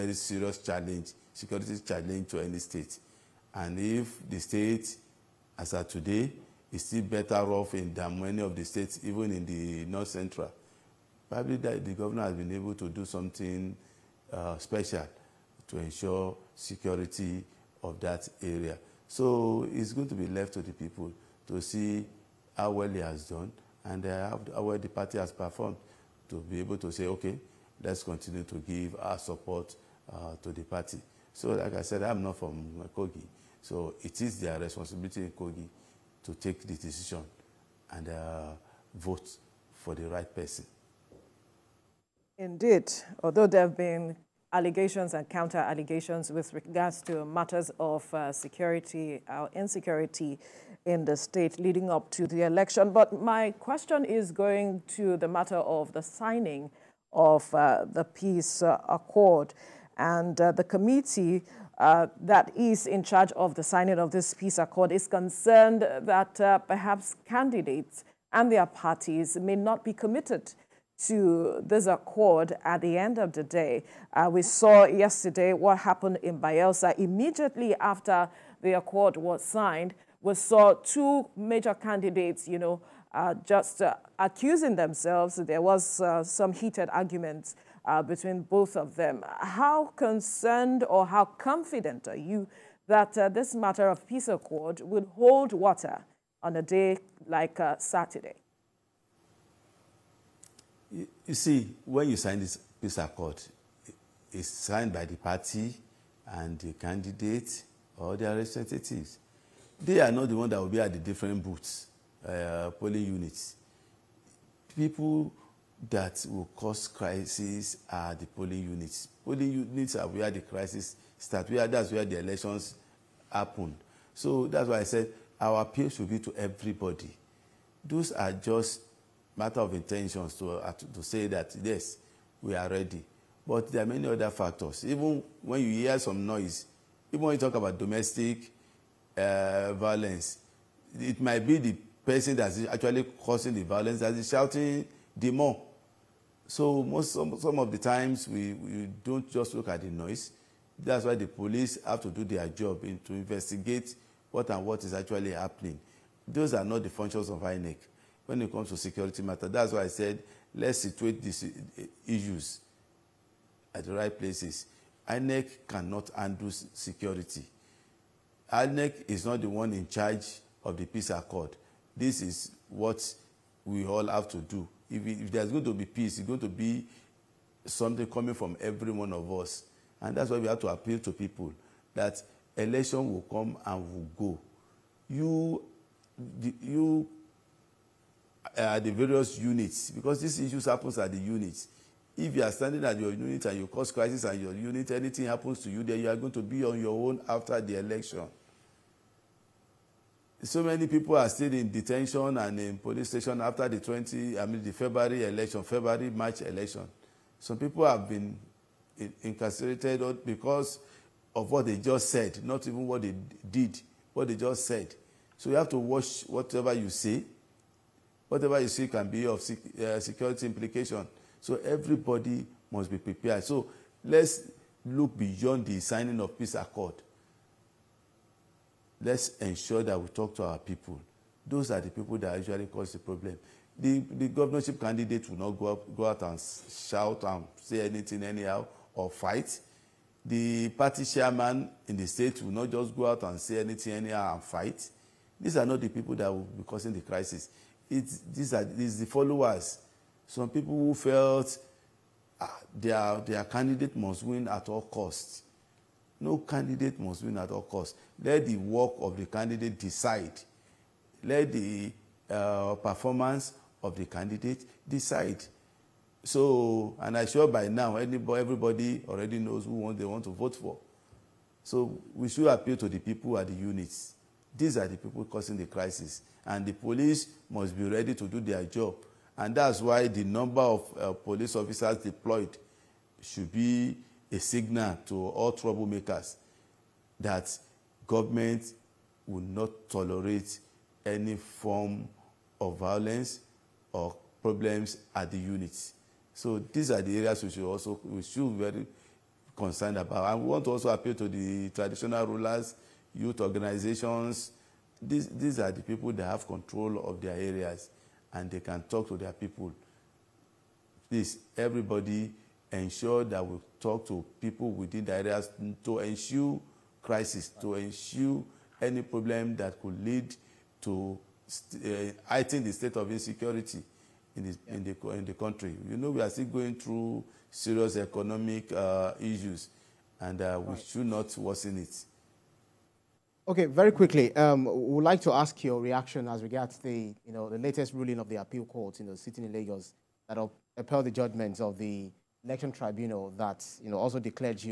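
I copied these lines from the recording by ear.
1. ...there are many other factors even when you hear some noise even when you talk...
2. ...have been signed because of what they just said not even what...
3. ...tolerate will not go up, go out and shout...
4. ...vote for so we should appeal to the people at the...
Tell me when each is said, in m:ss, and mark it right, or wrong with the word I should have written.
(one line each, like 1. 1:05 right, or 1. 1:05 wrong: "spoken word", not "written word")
1. 2:13 right
2. 3:27 wrong: "incarcerated", not "signed"
3. 3:54 wrong: "candidate", not "tolerate"
4. 4:30 right.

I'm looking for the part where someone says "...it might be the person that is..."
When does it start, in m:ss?
2:20.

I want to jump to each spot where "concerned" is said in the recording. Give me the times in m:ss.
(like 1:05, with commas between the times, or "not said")
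1:05, 1:29, 4:59.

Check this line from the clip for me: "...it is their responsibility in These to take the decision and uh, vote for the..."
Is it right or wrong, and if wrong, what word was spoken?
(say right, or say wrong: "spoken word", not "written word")
wrong: "Kogi", not "These".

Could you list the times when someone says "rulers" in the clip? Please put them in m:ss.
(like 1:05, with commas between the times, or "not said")
5:02.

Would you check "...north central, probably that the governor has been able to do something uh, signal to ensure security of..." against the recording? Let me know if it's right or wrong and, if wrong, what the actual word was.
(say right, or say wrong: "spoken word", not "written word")
wrong: "special", not "signal".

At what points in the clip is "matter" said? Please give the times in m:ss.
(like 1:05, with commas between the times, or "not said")
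0:47, 0:55, 1:33, 2:09, 2:39.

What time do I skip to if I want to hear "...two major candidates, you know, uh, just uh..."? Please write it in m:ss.
1:20.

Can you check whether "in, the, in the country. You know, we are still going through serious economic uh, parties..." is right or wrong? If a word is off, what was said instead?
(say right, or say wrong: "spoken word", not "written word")
wrong: "issues", not "parties".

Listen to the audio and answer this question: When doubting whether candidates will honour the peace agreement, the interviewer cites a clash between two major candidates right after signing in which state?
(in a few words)
Bayelsa.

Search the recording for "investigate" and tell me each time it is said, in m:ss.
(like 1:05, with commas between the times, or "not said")
2:33.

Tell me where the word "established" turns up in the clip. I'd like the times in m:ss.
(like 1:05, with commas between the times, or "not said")
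not said.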